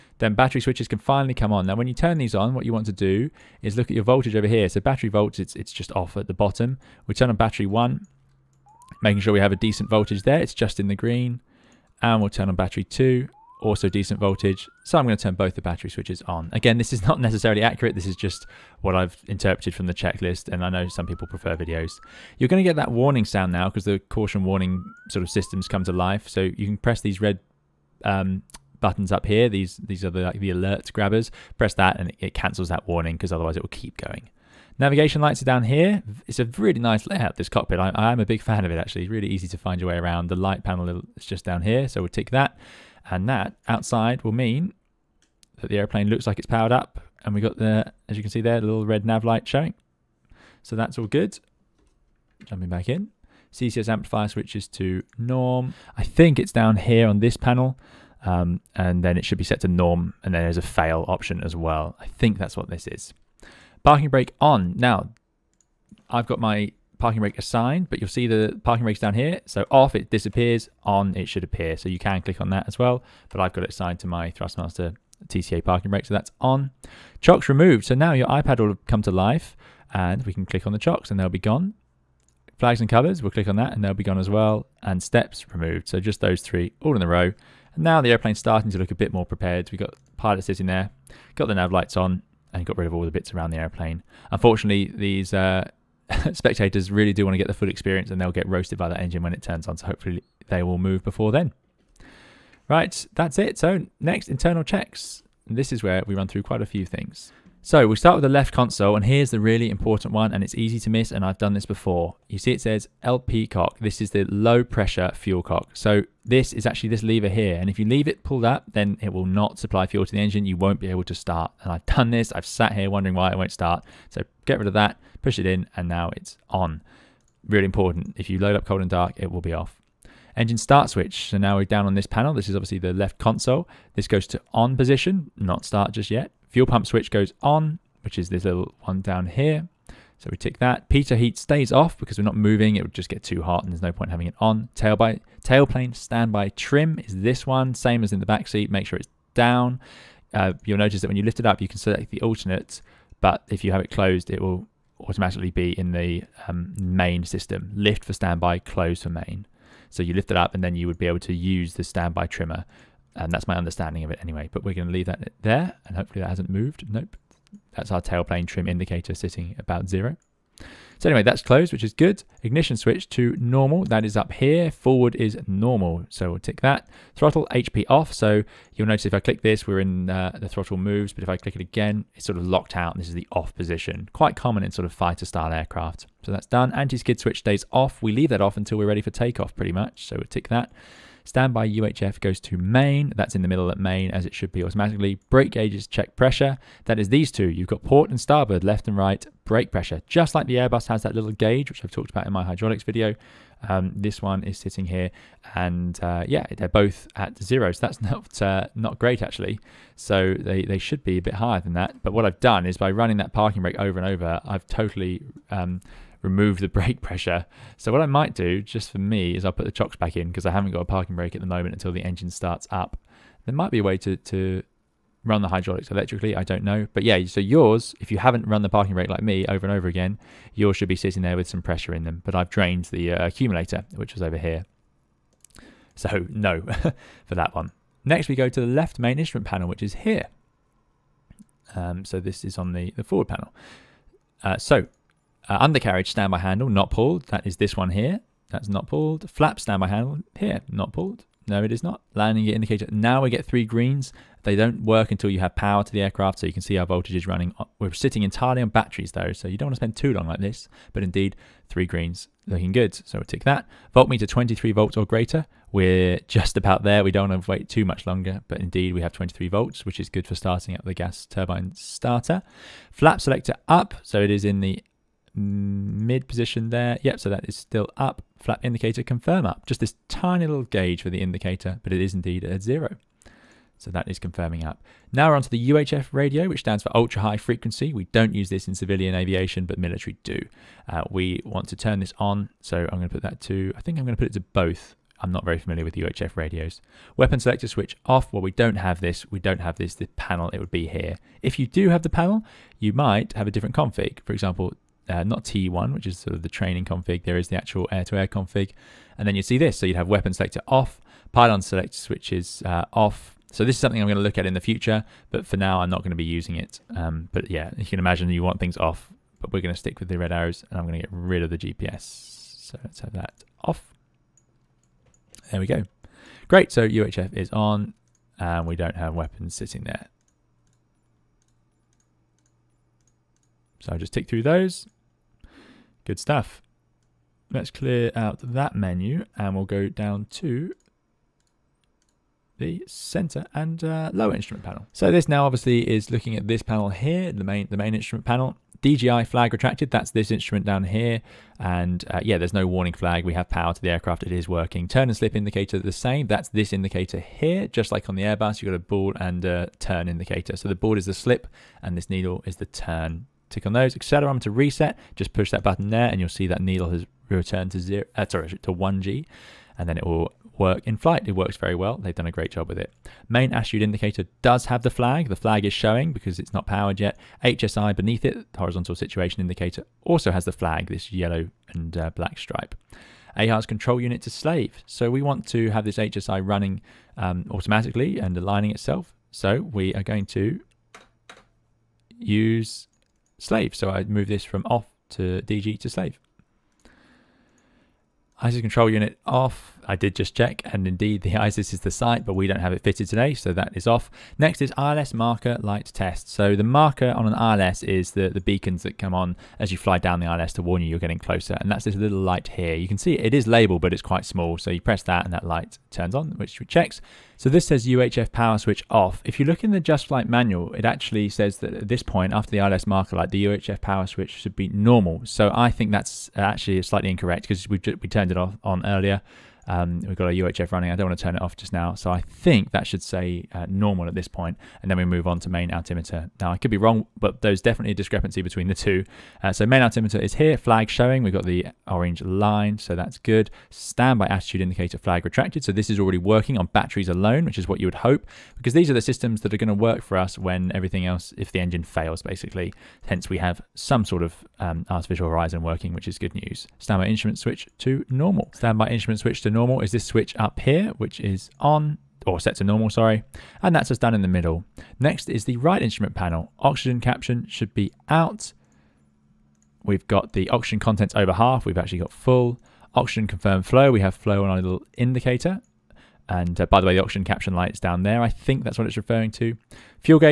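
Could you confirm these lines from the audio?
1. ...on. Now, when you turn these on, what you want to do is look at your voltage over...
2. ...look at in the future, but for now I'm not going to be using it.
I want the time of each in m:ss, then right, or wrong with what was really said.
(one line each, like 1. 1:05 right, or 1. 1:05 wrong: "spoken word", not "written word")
1. 0:01 right
2. 5:14 right.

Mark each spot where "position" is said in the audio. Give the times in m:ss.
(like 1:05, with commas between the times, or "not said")
2:14, 3:03, 4:36.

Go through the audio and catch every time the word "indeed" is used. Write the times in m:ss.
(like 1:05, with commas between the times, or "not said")
4:21, 4:28, 4:42, 6:40.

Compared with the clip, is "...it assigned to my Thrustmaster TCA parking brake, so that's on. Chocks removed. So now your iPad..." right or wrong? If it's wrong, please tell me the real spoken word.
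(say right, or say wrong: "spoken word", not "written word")
right.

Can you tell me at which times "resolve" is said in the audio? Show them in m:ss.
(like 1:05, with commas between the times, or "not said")
not said.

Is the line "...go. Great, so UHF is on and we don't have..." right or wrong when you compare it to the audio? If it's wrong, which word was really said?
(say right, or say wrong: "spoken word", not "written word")
right.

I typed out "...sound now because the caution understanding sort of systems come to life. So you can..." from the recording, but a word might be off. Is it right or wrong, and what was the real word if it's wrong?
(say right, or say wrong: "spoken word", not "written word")
wrong: "warning", not "understanding".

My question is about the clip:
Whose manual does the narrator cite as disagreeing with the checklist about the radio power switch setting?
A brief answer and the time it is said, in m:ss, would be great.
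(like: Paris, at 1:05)
Just Flight, at 6:59.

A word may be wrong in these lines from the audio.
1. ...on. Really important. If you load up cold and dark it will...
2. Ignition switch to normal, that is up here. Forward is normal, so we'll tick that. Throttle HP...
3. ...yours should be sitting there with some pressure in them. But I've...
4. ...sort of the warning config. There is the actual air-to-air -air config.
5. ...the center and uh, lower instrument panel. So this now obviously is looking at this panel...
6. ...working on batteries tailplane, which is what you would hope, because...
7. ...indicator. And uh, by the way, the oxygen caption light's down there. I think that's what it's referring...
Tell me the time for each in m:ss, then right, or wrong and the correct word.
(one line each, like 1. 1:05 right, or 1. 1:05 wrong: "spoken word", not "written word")
1. 2:06 right
2. 2:52 right
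3. 3:50 right
4. 5:06 wrong: "training", not "warning"
5. 5:42 right
6. 7:26 wrong: "alone", not "tailplane"
7. 7:54 right.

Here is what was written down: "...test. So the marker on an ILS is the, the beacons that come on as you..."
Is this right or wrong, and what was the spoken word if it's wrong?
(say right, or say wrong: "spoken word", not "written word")
right.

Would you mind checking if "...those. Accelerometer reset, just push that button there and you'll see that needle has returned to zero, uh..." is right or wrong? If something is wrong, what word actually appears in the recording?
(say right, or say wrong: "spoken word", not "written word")
right.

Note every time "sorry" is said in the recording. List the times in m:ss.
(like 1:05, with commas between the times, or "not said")
6:08, 7:42.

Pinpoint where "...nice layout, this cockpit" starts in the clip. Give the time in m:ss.
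0:36.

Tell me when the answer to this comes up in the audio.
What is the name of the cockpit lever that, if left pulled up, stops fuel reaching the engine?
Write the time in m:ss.
1:53.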